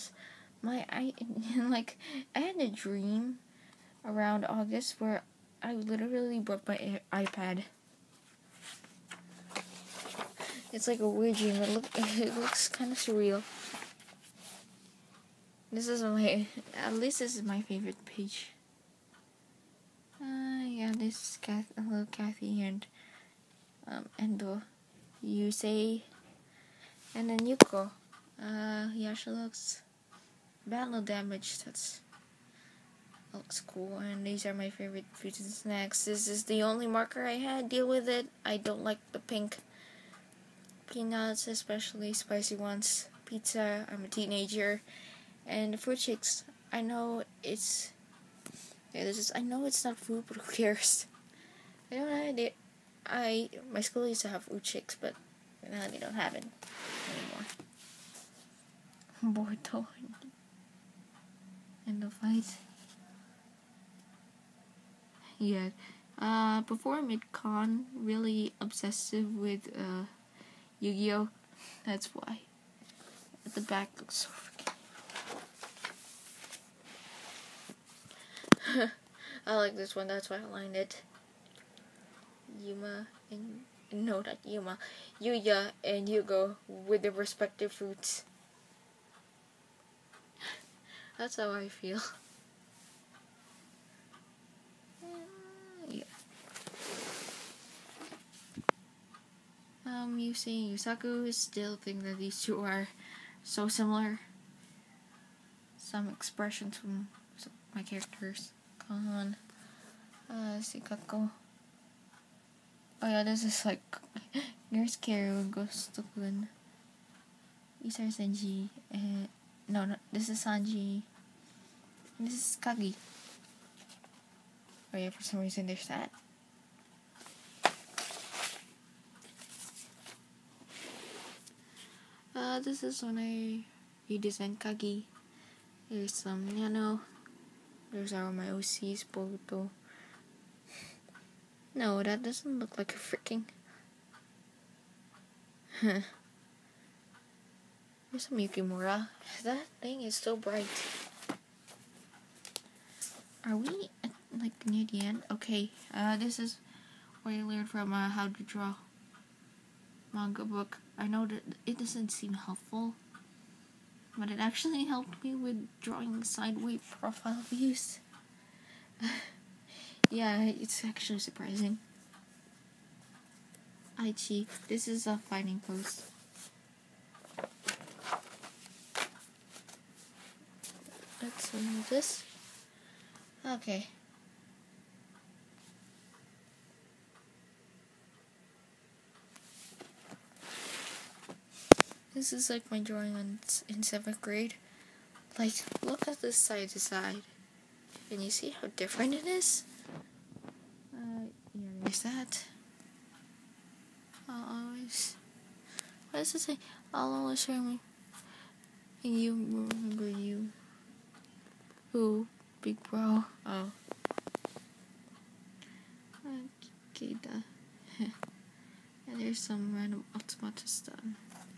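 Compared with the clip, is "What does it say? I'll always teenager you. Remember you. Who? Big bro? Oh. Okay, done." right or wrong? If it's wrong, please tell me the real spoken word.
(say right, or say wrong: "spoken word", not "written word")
wrong: "remember", not "teenager".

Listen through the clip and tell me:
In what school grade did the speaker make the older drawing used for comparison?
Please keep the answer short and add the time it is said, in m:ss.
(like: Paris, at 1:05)
Seventh grade, at 3:13.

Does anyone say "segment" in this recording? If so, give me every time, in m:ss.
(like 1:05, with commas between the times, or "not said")
not said.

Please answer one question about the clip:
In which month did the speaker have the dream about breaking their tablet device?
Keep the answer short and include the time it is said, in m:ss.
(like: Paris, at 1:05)
August, at 0:04.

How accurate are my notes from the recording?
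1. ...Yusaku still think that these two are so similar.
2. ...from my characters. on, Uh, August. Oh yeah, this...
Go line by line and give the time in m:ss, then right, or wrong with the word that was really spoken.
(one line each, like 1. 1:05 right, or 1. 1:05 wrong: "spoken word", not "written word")
1. 1:40 right
2. 1:46 wrong: "Sikako", not "August".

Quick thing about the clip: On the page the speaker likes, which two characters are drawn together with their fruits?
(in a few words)
Yuya and Yugo.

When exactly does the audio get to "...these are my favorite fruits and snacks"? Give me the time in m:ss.
0:34.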